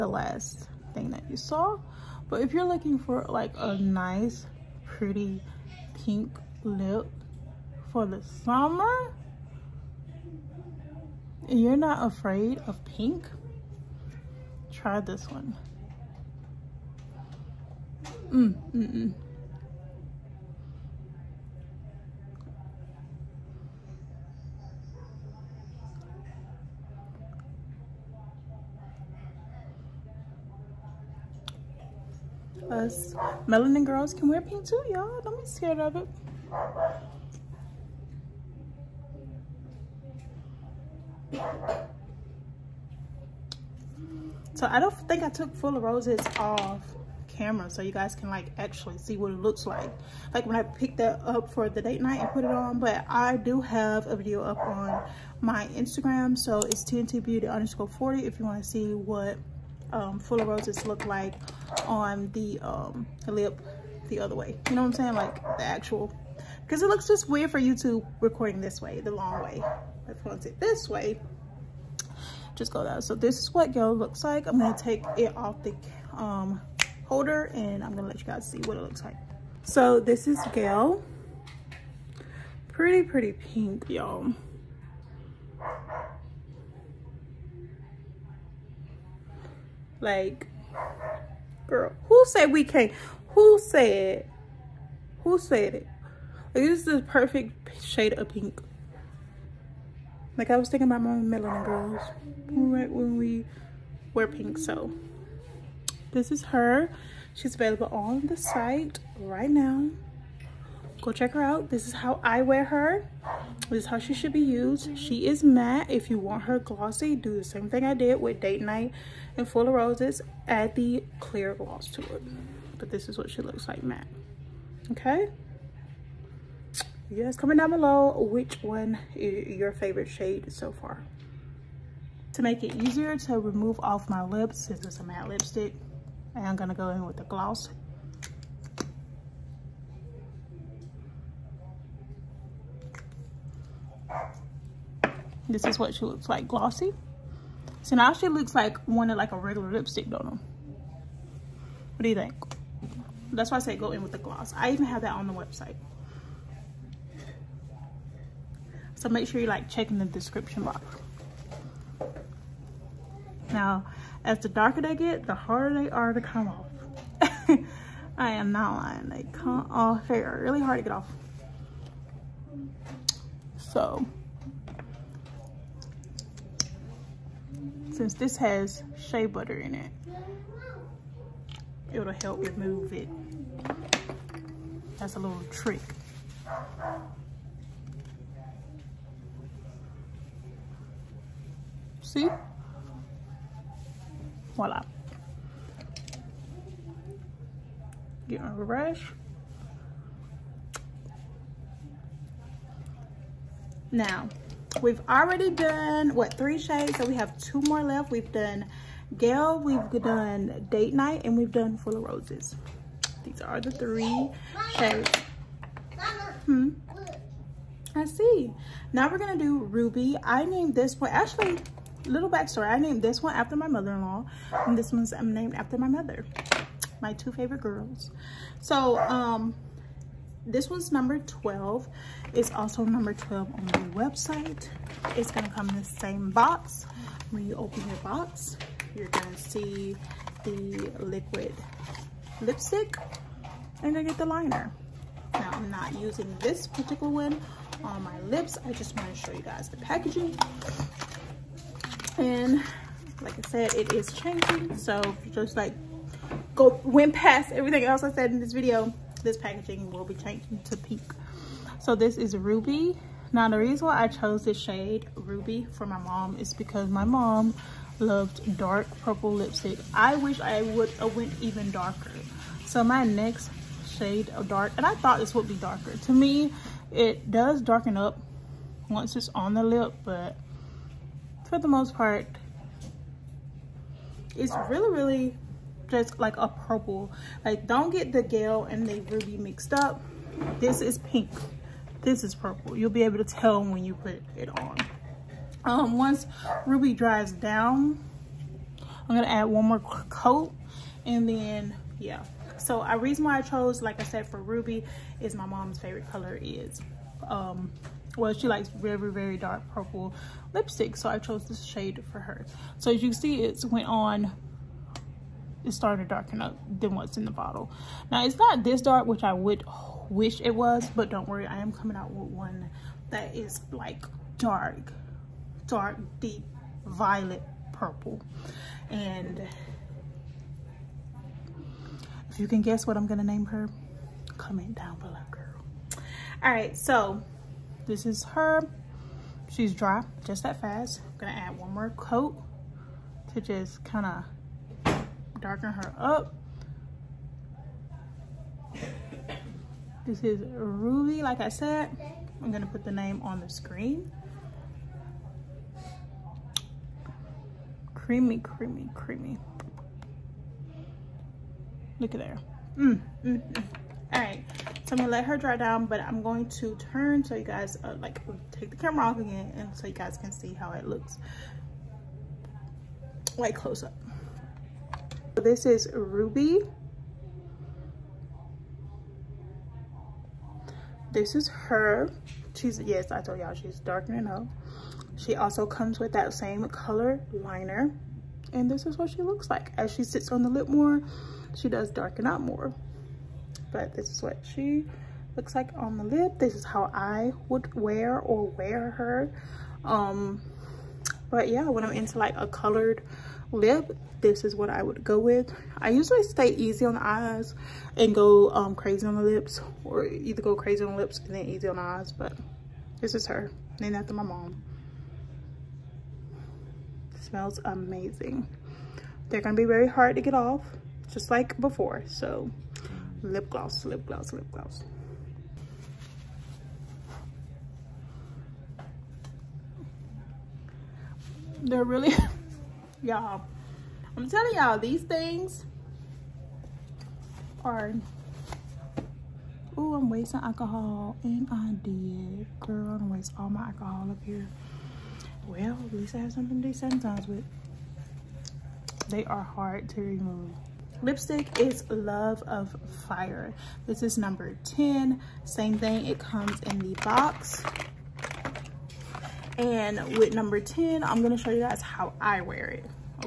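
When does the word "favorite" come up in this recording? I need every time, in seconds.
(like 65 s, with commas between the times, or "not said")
129 s, 227 s, 305 s.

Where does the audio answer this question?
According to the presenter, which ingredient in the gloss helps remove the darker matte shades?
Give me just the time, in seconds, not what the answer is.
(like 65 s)
178 s.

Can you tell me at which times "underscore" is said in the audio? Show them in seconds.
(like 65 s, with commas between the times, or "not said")
57 s.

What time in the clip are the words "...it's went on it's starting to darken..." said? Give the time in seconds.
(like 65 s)
313 s.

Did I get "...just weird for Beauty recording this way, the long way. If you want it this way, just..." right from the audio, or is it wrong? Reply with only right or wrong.
wrong.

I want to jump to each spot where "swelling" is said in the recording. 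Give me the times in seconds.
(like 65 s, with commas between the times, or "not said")
not said.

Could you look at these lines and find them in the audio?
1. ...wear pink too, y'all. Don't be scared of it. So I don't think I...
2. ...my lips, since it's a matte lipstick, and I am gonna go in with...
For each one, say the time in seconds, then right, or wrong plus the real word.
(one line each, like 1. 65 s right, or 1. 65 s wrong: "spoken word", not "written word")
1. 34 s right
2. 134 s right.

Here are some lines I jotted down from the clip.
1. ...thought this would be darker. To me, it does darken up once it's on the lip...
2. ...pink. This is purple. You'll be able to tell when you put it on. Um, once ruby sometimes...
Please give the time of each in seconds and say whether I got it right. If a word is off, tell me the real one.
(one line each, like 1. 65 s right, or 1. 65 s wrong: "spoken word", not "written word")
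1. 274 s right
2. 290 s wrong: "dries", not "sometimes".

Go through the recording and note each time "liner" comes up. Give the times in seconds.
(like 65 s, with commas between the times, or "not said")
244 s, 387 s.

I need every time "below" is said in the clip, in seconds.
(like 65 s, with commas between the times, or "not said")
127 s, 334 s.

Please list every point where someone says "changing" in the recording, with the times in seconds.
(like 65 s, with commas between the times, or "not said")
254 s, 260 s.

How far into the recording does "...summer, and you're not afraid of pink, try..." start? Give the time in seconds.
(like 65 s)
8 s.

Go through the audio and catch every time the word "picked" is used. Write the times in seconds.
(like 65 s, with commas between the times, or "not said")
50 s.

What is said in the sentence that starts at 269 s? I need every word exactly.
I wish I would have went even darker.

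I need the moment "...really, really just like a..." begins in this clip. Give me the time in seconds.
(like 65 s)
284 s.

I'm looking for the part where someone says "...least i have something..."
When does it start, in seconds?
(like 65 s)
445 s.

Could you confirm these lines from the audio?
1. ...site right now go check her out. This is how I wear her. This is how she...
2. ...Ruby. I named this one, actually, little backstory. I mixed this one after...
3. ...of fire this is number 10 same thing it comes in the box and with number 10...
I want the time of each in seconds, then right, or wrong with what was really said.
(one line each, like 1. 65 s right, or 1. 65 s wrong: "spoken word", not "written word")
1. 108 s right
2. 219 s wrong: "named", not "mixed"
3. 452 s right.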